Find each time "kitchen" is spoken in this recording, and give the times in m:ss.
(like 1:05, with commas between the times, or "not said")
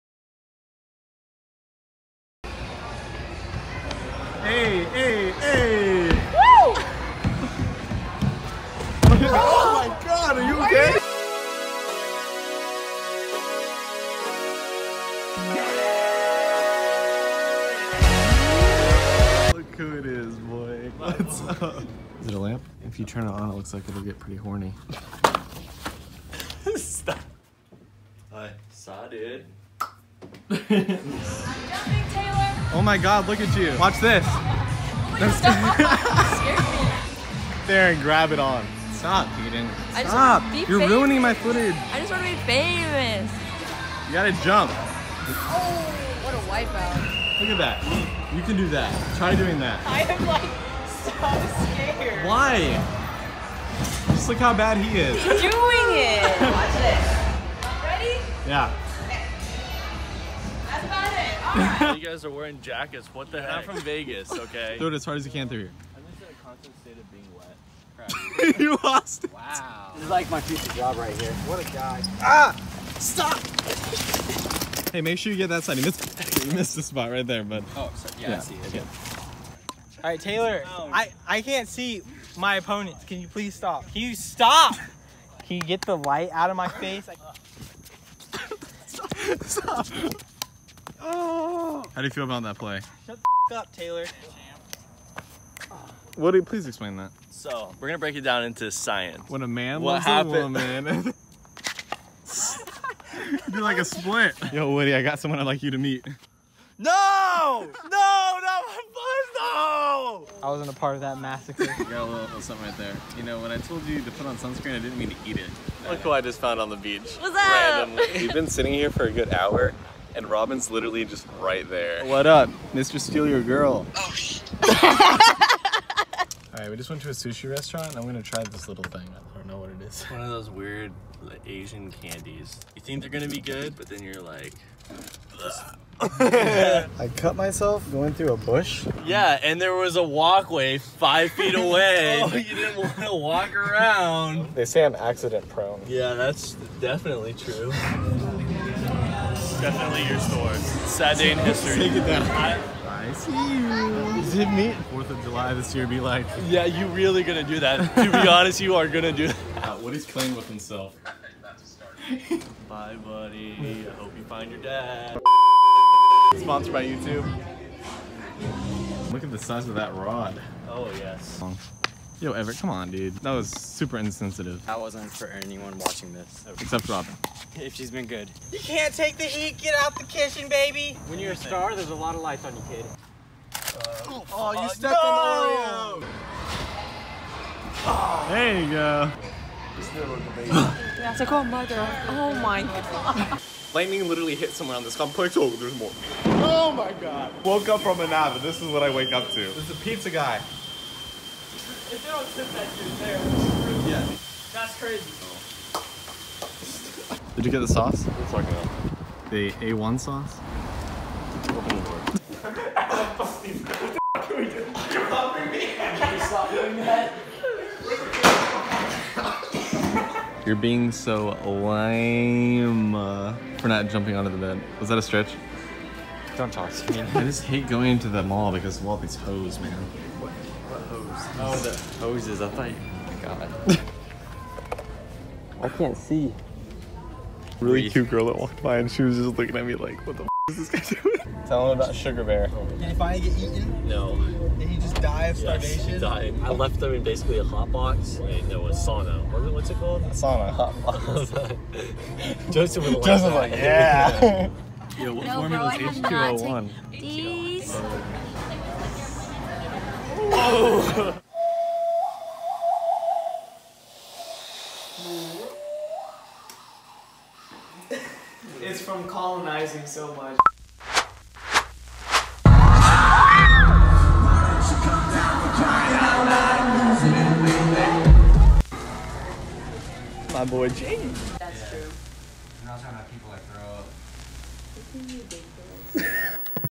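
3:00.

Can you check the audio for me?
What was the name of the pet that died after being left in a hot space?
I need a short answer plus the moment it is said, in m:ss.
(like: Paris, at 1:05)
Sugar Bear, at 4:01.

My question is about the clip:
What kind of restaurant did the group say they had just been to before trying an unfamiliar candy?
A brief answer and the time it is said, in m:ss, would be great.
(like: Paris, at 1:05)
sushi restaurant, at 2:07.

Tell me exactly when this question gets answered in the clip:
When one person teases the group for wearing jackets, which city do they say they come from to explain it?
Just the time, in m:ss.
1:03.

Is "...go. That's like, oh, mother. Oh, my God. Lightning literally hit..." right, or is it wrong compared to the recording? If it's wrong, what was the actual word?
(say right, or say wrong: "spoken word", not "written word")
right.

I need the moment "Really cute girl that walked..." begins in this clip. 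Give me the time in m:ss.
3:57.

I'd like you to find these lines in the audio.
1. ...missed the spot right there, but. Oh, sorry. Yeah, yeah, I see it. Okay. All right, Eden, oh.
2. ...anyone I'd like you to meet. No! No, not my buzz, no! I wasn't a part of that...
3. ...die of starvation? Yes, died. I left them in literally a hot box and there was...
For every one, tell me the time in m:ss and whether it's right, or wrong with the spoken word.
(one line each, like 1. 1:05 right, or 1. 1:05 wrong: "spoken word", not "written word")
1. 1:16 wrong: "Taylor", not "Eden"
2. 1:45 wrong: "someone", not "anyone"
3. 4:04 wrong: "basically", not "literally".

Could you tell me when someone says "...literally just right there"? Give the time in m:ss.
2:00.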